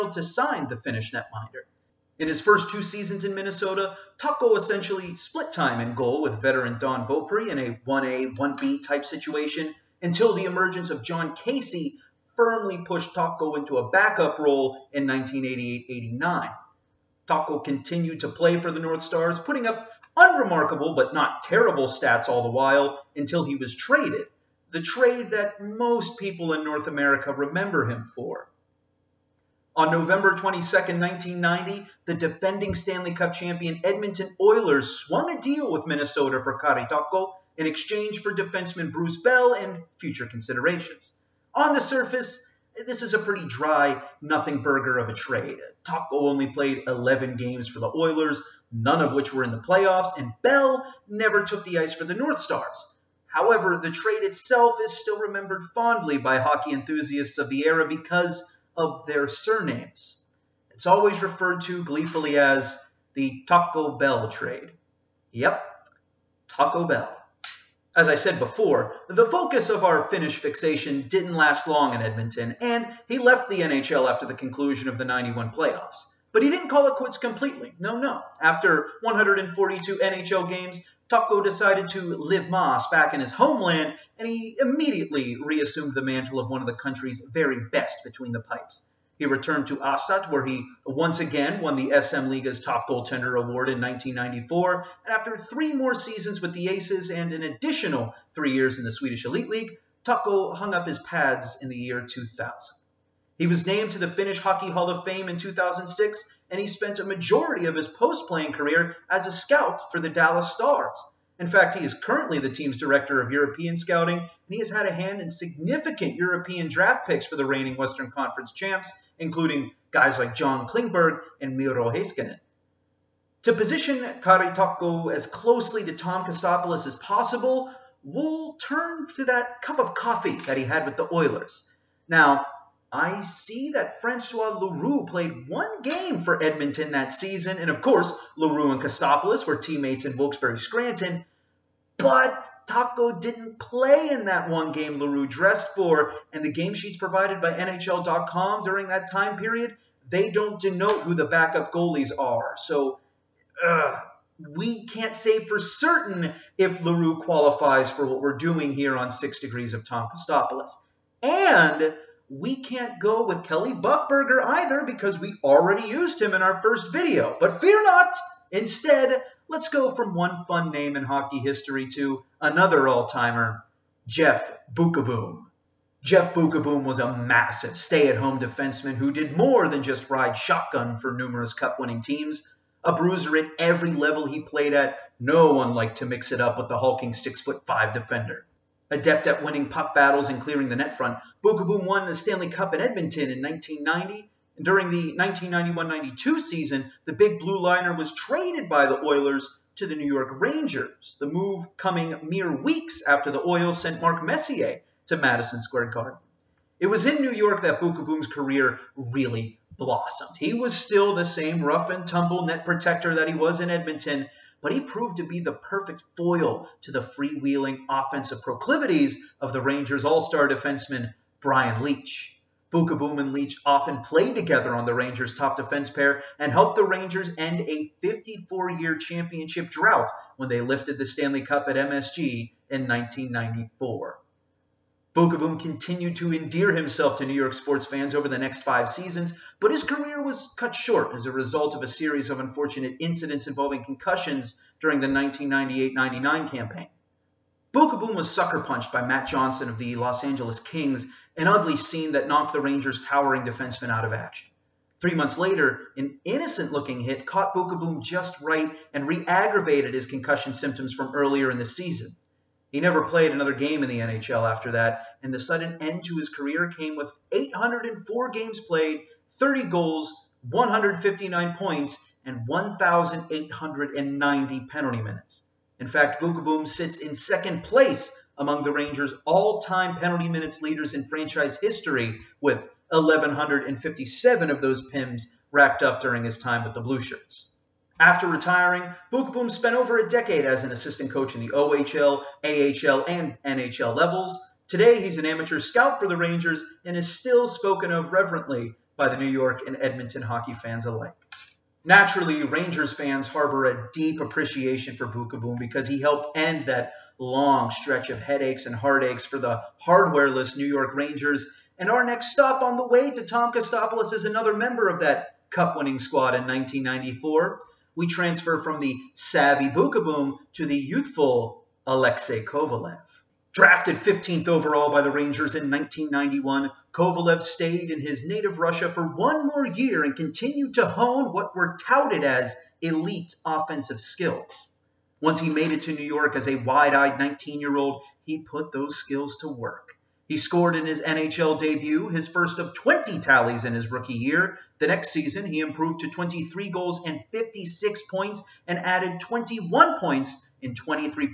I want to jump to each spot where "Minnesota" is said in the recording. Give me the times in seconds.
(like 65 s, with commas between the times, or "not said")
3 s, 35 s.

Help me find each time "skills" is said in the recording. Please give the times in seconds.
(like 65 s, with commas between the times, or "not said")
334 s, 338 s.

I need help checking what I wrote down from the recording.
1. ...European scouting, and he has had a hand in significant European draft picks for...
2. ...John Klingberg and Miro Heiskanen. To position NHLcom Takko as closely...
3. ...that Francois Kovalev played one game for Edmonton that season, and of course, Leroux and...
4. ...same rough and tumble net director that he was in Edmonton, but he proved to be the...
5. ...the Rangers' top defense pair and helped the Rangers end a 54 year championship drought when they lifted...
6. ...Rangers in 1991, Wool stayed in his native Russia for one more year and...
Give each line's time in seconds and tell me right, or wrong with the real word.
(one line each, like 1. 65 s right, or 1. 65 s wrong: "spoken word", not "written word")
1. 113 s right
2. 120 s wrong: "Kari", not "NHLcom"
3. 133 s wrong: "Leroux", not "Kovalev"
4. 211 s wrong: "protector", not "director"
5. 224 s right
6. 325 s wrong: "Kovalev", not "Wool".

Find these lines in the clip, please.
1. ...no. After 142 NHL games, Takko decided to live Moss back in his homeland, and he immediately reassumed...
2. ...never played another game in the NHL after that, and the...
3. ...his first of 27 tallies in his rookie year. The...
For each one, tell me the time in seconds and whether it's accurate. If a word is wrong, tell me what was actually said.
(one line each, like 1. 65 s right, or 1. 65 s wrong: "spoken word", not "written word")
1. 77 s right
2. 262 s right
3. 342 s wrong: "20", not "27".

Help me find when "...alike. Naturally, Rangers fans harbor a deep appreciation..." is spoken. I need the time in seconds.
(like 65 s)
300 s.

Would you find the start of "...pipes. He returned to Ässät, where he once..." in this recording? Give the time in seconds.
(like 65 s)
88 s.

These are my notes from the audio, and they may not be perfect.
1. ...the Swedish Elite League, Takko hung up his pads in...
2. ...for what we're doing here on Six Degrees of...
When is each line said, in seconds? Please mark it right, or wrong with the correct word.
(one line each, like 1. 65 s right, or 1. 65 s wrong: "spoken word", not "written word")
1. 98 s right
2. 157 s right.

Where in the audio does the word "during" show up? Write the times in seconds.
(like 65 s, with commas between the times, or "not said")
148 s, 194 s, 244 s, 286 s.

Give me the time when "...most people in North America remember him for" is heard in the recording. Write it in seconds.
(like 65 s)
25 s.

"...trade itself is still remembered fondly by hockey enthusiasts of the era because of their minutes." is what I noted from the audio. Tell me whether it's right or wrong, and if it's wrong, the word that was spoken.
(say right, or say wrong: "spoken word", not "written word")
wrong: "surnames", not "minutes".